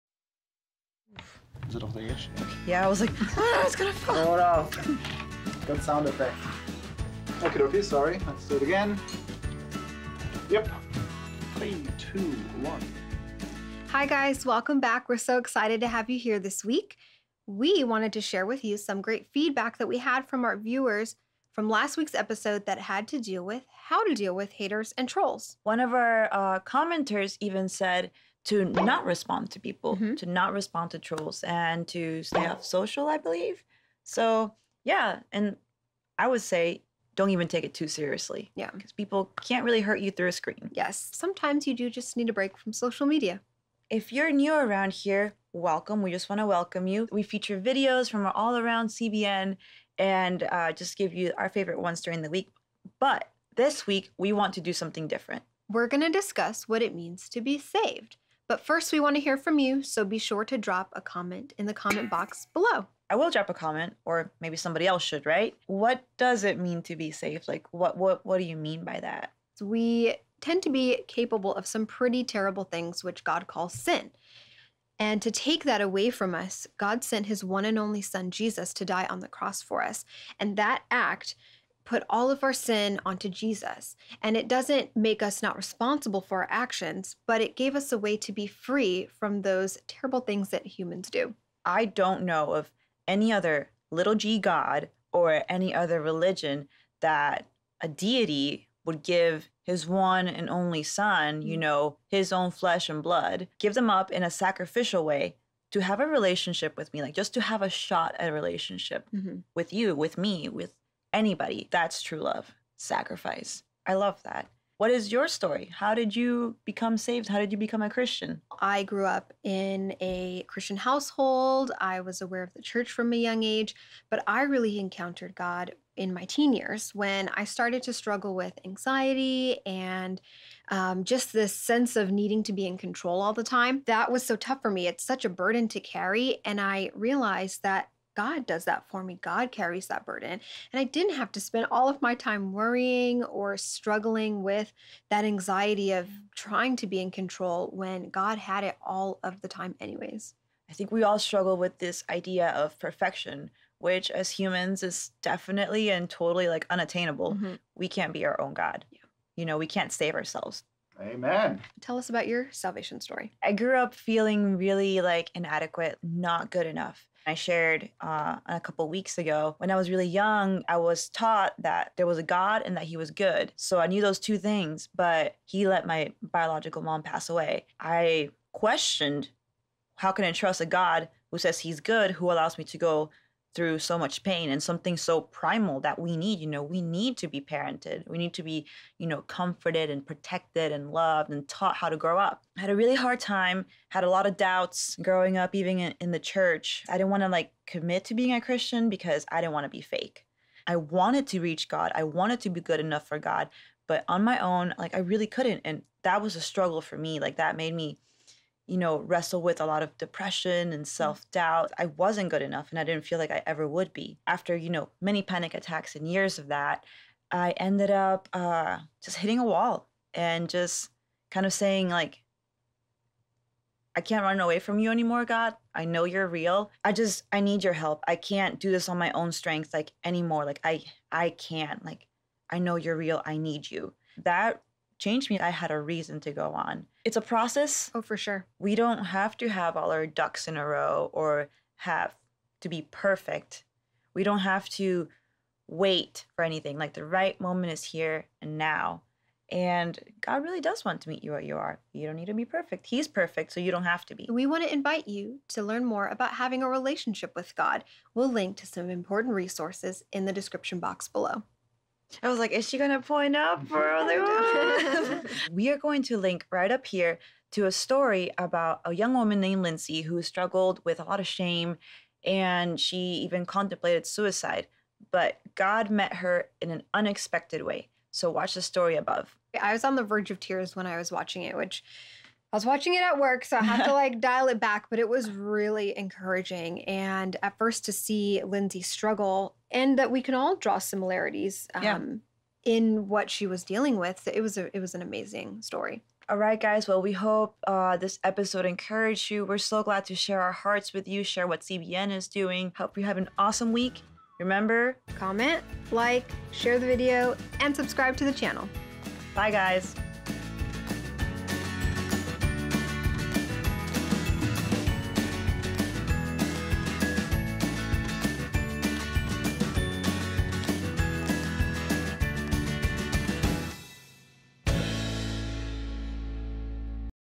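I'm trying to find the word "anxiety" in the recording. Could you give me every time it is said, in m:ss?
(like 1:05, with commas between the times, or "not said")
2:08, 2:25.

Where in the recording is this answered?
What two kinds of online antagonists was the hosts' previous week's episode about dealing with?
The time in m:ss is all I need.
0:24.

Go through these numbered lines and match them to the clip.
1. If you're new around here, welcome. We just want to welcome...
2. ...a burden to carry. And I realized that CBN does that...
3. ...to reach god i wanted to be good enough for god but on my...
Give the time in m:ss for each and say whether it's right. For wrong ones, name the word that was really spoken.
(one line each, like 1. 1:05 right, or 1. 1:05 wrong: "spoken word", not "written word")
1. 0:43 right
2. 2:15 wrong: "God", not "CBN"
3. 3:21 right.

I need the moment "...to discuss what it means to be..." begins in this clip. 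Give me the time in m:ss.
0:56.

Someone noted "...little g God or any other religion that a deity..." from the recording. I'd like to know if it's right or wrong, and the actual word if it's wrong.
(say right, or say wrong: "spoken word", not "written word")
right.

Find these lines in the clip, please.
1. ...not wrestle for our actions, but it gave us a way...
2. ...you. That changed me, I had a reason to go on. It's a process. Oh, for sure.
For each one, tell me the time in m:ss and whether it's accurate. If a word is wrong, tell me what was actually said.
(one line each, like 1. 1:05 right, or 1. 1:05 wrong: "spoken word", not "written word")
1. 1:25 wrong: "responsible", not "wrestle"
2. 3:53 right.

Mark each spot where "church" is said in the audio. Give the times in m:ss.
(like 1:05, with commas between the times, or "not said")
2:02, 3:16.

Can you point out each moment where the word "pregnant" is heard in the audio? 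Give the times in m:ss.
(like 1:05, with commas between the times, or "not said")
not said.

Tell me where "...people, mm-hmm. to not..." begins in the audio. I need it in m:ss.
0:29.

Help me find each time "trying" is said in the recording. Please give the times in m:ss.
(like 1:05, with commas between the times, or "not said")
2:26.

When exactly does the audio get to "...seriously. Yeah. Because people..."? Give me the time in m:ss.
0:37.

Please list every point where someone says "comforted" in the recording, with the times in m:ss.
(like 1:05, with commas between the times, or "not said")
3:09.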